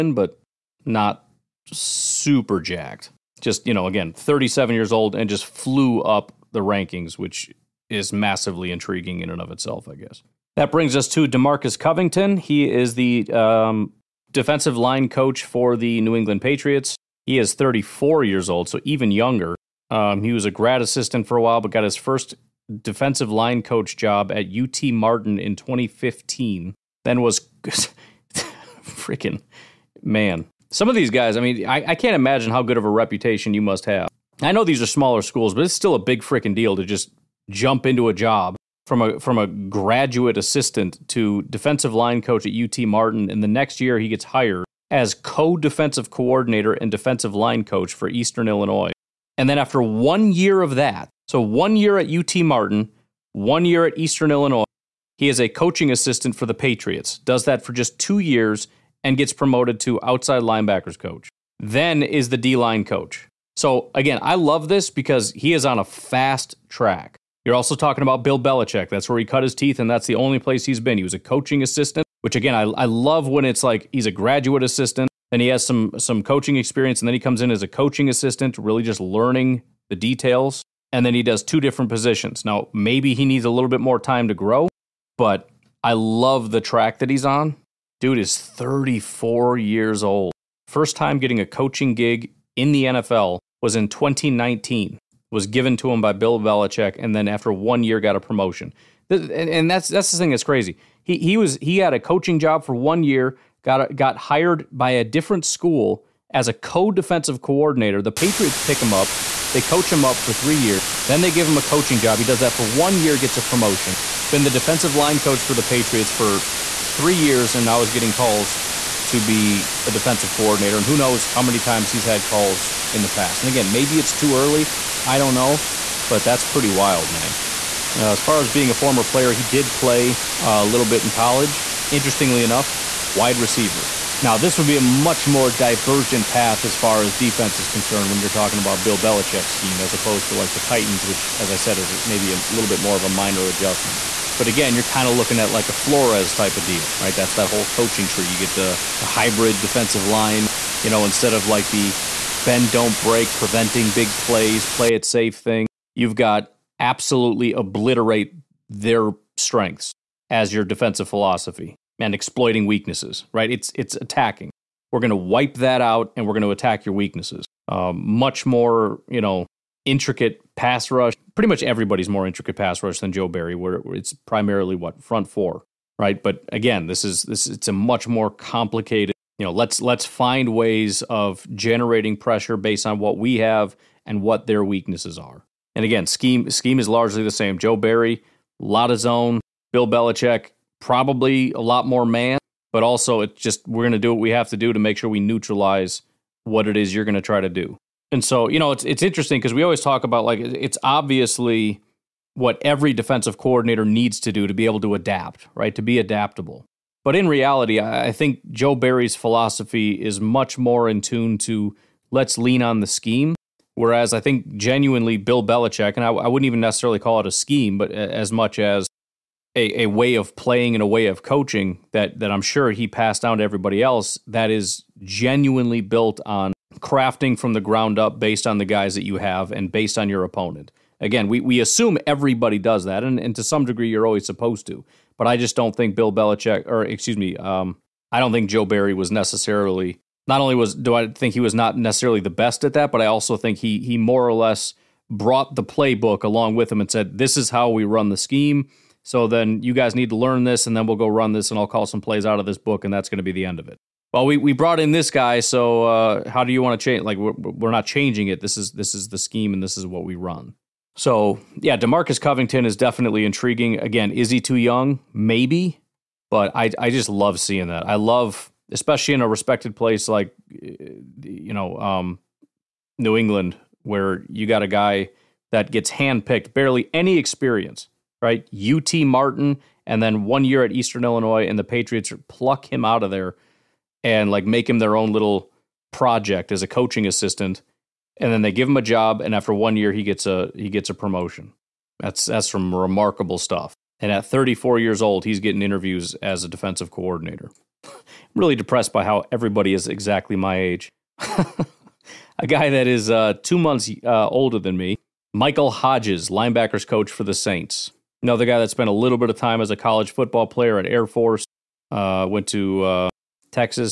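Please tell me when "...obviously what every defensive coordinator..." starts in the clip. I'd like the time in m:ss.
3:20.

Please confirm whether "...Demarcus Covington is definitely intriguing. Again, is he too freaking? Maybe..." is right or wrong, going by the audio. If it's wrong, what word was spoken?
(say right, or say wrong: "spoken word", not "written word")
wrong: "young", not "freaking".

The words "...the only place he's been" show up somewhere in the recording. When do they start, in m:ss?
1:10.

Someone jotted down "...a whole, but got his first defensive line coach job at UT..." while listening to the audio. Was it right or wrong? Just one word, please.
wrong.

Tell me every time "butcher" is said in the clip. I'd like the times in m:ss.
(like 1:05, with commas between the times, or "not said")
not said.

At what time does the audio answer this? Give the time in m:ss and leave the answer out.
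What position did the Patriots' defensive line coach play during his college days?
2:13.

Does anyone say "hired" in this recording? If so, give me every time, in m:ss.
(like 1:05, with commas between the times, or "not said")
0:44, 1:44.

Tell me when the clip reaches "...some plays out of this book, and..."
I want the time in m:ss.
4:11.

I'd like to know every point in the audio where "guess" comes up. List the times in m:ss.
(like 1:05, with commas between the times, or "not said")
0:09.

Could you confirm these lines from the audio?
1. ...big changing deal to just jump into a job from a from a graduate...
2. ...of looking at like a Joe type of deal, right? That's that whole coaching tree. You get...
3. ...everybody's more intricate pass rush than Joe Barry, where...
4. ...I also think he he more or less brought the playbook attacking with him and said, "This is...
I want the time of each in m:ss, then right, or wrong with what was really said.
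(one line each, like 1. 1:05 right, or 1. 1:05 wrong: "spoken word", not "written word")
1. 0:35 wrong: "freaking", not "changing"
2. 2:25 wrong: "Flores", not "Joe"
3. 2:51 right
4. 4:03 wrong: "along", not "attacking".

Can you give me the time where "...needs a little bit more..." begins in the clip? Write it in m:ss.
1:23.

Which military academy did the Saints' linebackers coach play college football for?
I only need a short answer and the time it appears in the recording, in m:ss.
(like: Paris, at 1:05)
Air Force, at 5:10.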